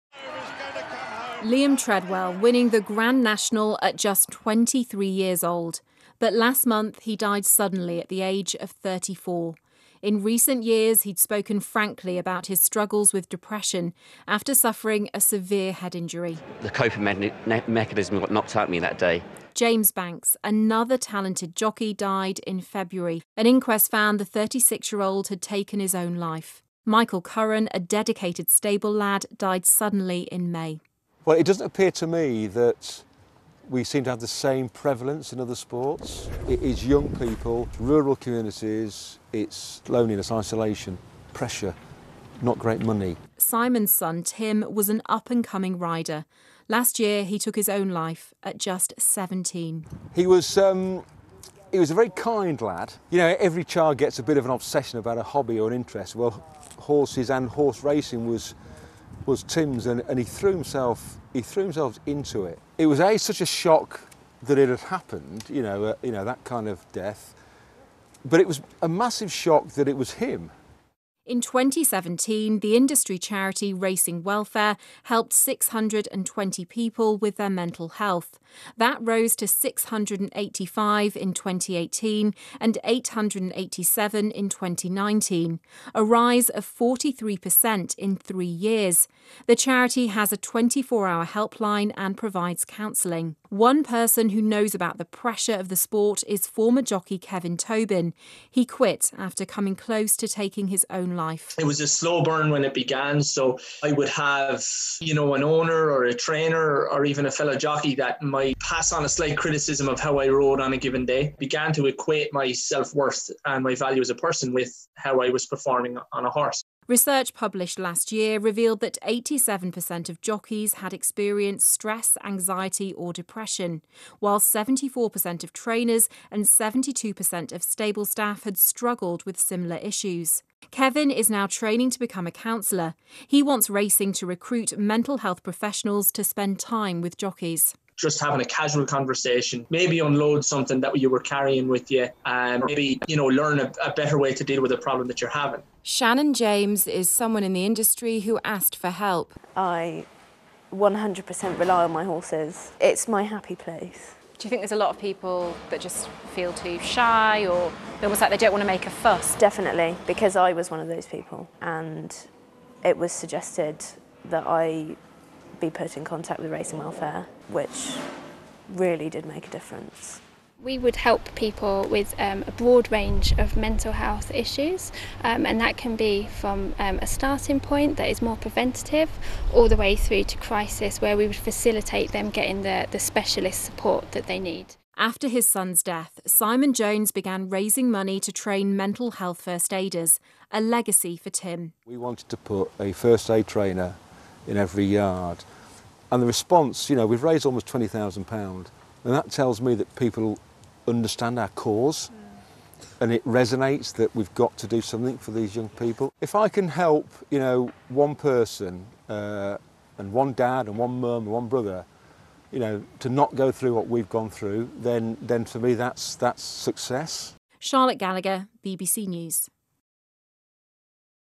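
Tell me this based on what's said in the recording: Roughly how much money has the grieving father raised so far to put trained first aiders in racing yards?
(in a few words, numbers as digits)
£20,000.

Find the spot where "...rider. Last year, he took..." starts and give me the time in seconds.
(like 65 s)
45 s.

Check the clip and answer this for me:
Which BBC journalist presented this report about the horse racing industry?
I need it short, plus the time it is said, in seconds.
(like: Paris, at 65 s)
Charlotte Gallagher, at 217 s.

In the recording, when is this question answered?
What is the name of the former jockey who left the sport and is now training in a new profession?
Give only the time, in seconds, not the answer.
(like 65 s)
97 s.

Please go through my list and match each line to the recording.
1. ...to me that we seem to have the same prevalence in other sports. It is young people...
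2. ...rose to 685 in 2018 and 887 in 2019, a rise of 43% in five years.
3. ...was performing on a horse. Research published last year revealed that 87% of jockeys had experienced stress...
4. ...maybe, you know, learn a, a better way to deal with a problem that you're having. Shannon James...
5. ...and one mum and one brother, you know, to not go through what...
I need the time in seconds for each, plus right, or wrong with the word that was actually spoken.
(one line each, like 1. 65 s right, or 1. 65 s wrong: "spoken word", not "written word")
1. 31 s right
2. 78 s wrong: "three", not "five"
3. 115 s right
4. 142 s right
5. 210 s right.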